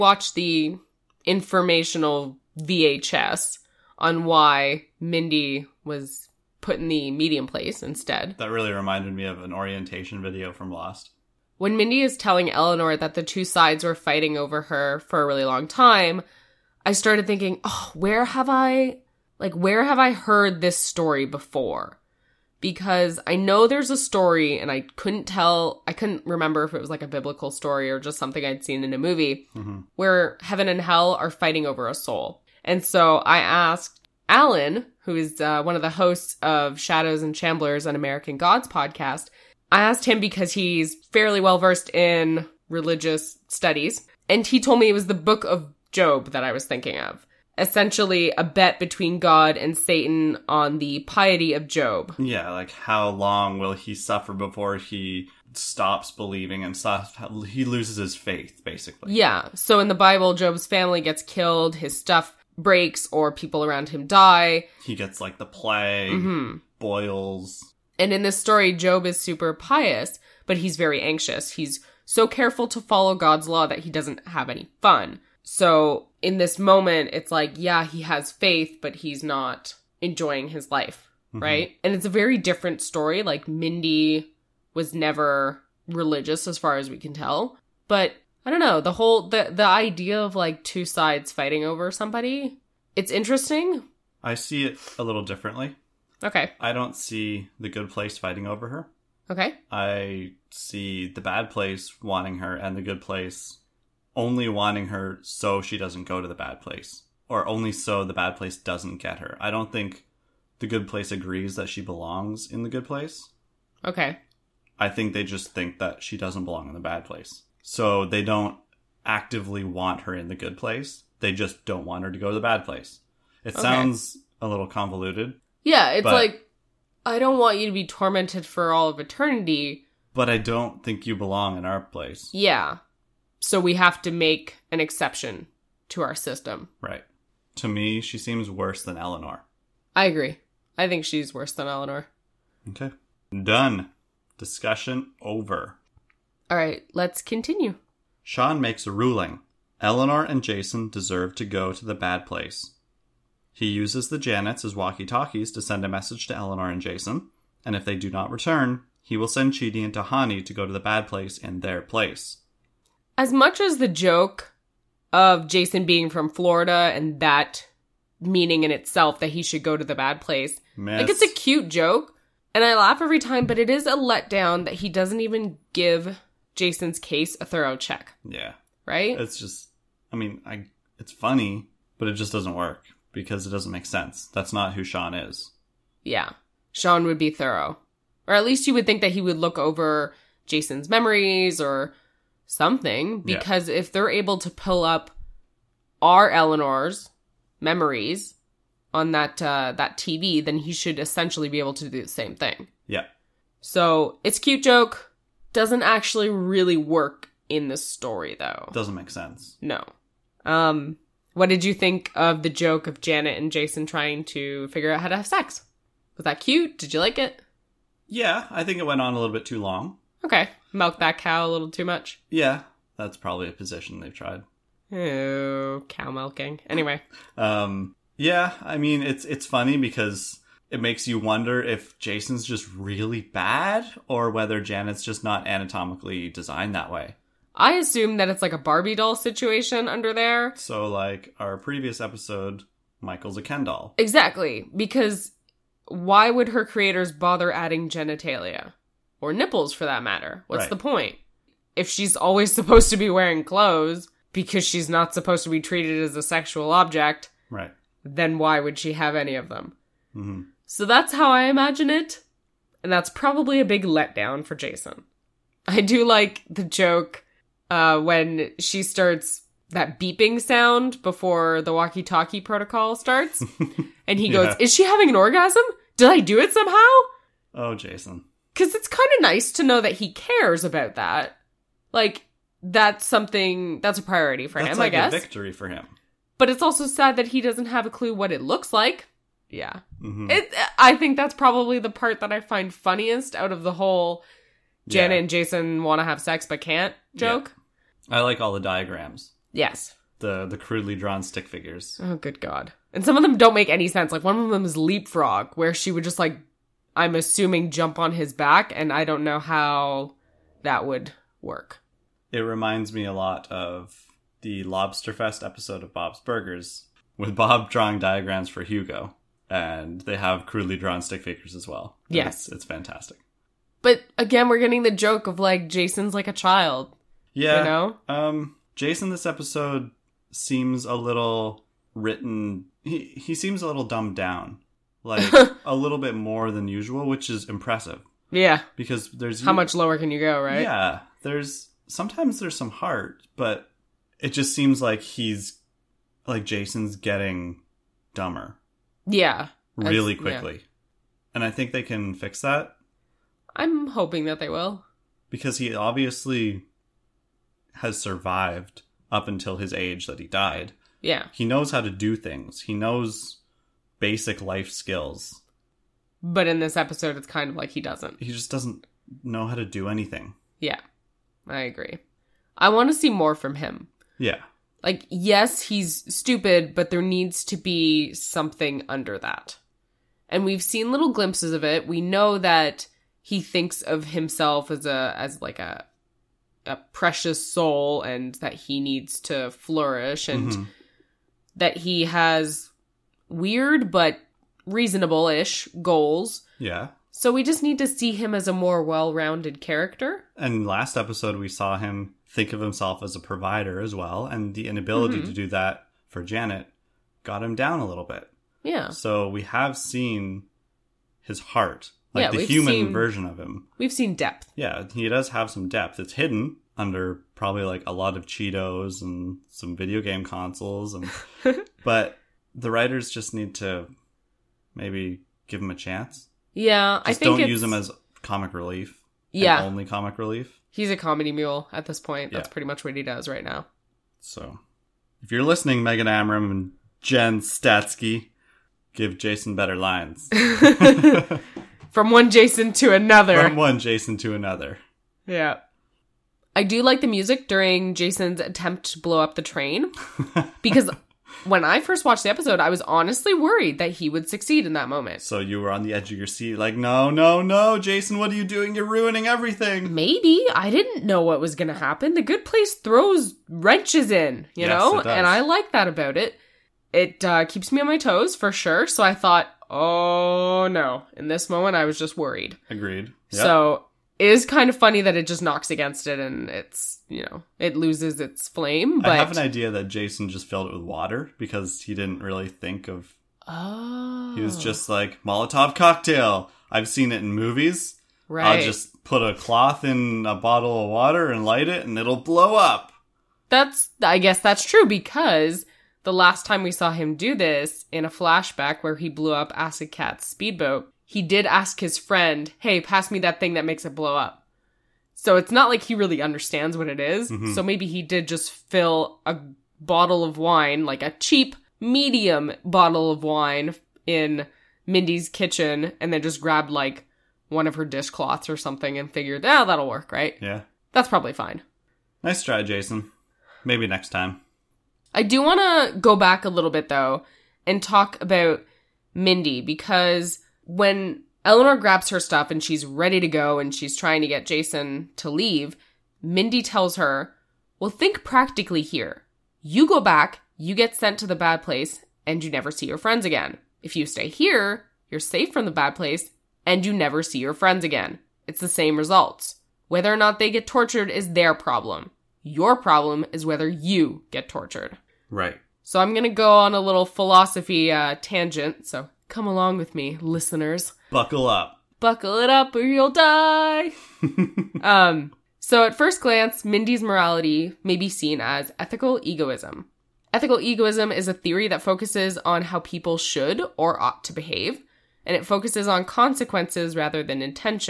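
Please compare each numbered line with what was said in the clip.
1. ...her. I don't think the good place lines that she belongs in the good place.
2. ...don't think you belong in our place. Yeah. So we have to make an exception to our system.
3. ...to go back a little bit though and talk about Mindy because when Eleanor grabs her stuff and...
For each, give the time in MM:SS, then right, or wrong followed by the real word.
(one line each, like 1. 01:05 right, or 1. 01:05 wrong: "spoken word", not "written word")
1. 01:49 wrong: "agrees", not "lines"
2. 02:10 right
3. 08:45 right.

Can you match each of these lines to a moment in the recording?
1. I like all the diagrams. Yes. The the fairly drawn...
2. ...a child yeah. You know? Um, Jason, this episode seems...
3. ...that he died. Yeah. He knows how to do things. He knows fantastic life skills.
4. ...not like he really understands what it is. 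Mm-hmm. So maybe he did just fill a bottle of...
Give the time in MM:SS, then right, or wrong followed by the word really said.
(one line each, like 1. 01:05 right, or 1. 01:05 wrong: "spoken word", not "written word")
1. 04:58 wrong: "crudely", not "fairly"
2. 05:26 right
3. 06:00 wrong: "basic", not "fantastic"
4. 08:25 right.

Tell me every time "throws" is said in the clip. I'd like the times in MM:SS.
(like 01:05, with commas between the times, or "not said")
07:42.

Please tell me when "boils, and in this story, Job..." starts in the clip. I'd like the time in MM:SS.
01:06.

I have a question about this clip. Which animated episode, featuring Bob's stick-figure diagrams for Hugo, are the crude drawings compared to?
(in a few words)
Lobsterfest.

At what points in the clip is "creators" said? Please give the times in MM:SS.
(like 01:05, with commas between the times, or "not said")
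04:06.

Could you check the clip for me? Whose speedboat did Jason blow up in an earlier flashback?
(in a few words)
Acid Cat.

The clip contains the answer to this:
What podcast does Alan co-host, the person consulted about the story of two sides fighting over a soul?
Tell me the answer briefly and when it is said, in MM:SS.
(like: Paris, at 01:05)
Shadows and Shamblers, at 00:36.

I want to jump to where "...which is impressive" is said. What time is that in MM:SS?
05:37.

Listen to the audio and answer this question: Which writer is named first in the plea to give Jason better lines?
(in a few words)
Megan Amram.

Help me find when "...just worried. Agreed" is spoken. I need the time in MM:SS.
07:51.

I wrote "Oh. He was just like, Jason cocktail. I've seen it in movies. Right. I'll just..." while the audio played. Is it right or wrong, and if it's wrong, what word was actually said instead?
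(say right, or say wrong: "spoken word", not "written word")
wrong: "Molotov", not "Jason".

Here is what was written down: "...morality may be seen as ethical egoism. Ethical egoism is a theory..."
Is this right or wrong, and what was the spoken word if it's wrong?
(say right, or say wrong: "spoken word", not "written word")
right.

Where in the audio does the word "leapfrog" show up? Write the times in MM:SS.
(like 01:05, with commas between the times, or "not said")
05:04.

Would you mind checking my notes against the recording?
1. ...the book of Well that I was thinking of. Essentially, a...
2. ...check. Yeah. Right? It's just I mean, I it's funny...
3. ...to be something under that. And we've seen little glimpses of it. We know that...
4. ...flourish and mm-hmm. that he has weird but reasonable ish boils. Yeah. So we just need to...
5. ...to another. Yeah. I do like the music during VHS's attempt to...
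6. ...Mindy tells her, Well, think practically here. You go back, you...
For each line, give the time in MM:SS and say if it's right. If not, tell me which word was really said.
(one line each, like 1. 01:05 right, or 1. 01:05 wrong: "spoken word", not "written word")
1. 00:45 wrong: "Job", not "Well"
2. 02:57 right
3. 06:17 right
4. 06:29 wrong: "goals", not "boils"
5. 07:24 wrong: "Jason", not "VHS"
6. 08:56 right.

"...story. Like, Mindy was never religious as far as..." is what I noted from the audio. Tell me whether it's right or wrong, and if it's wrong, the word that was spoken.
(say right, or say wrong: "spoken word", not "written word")
right.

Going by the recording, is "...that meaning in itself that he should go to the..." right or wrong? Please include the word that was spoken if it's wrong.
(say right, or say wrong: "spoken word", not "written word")
right.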